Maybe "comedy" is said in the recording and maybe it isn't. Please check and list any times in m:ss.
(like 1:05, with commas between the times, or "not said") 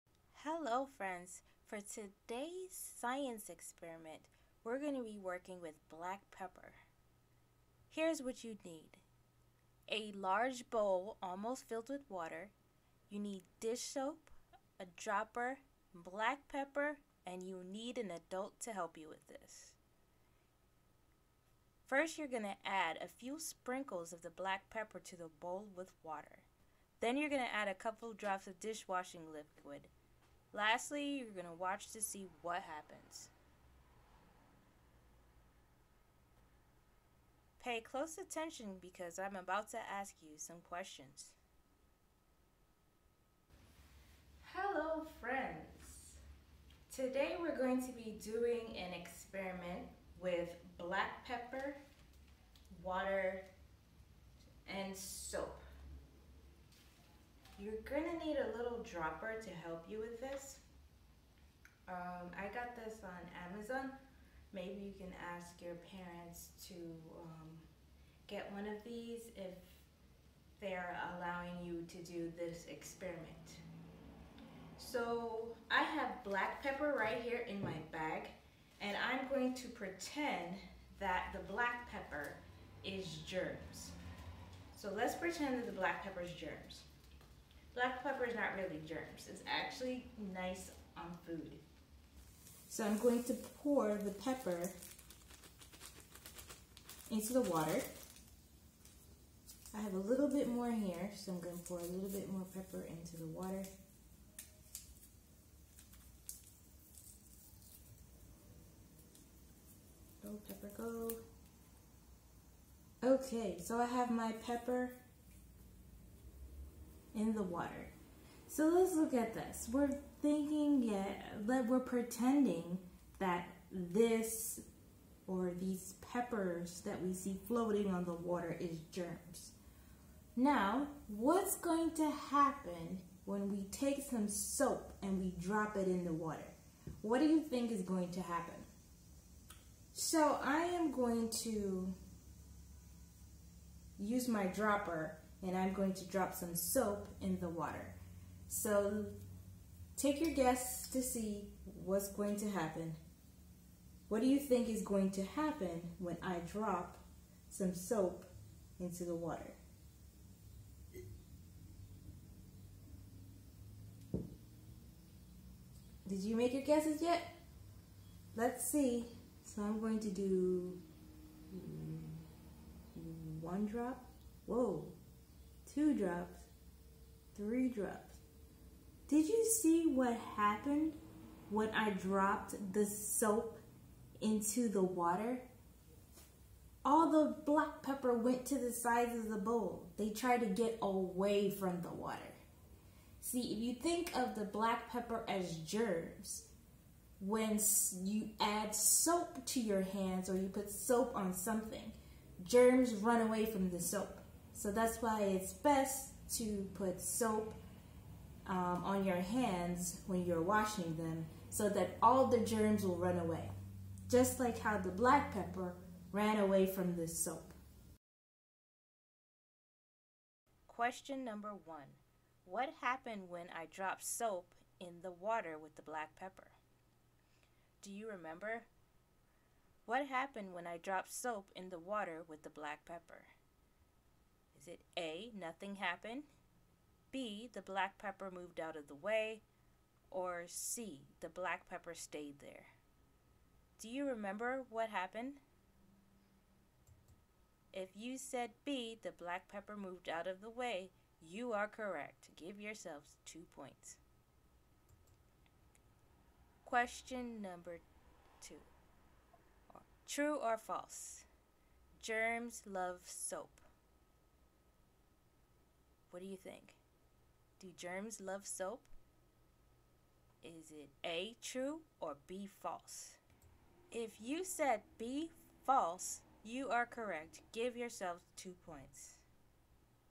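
not said.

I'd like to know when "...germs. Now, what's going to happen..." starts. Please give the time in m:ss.
2:08.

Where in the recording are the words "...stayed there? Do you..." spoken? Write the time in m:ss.
4:01.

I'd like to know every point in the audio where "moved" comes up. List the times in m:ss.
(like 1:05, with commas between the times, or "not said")
3:58, 4:09.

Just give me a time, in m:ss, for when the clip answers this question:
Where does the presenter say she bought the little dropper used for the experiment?
1:03.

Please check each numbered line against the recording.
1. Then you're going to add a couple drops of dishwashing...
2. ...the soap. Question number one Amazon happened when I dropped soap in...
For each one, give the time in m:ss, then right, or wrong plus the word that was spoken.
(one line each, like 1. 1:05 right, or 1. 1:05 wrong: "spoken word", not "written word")
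1. 0:26 right
2. 3:36 wrong: "What", not "Amazon".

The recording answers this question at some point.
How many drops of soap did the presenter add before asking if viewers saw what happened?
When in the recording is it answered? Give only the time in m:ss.
2:57.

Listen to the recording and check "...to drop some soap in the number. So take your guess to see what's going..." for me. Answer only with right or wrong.
wrong.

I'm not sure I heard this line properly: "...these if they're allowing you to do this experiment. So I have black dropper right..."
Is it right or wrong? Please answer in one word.
wrong.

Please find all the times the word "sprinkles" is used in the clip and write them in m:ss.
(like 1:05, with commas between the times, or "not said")
0:23.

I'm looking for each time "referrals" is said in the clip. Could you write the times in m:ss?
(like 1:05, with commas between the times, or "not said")
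not said.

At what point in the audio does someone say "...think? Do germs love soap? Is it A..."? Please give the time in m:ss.
4:26.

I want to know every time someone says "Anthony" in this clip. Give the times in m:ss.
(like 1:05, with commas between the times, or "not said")
not said.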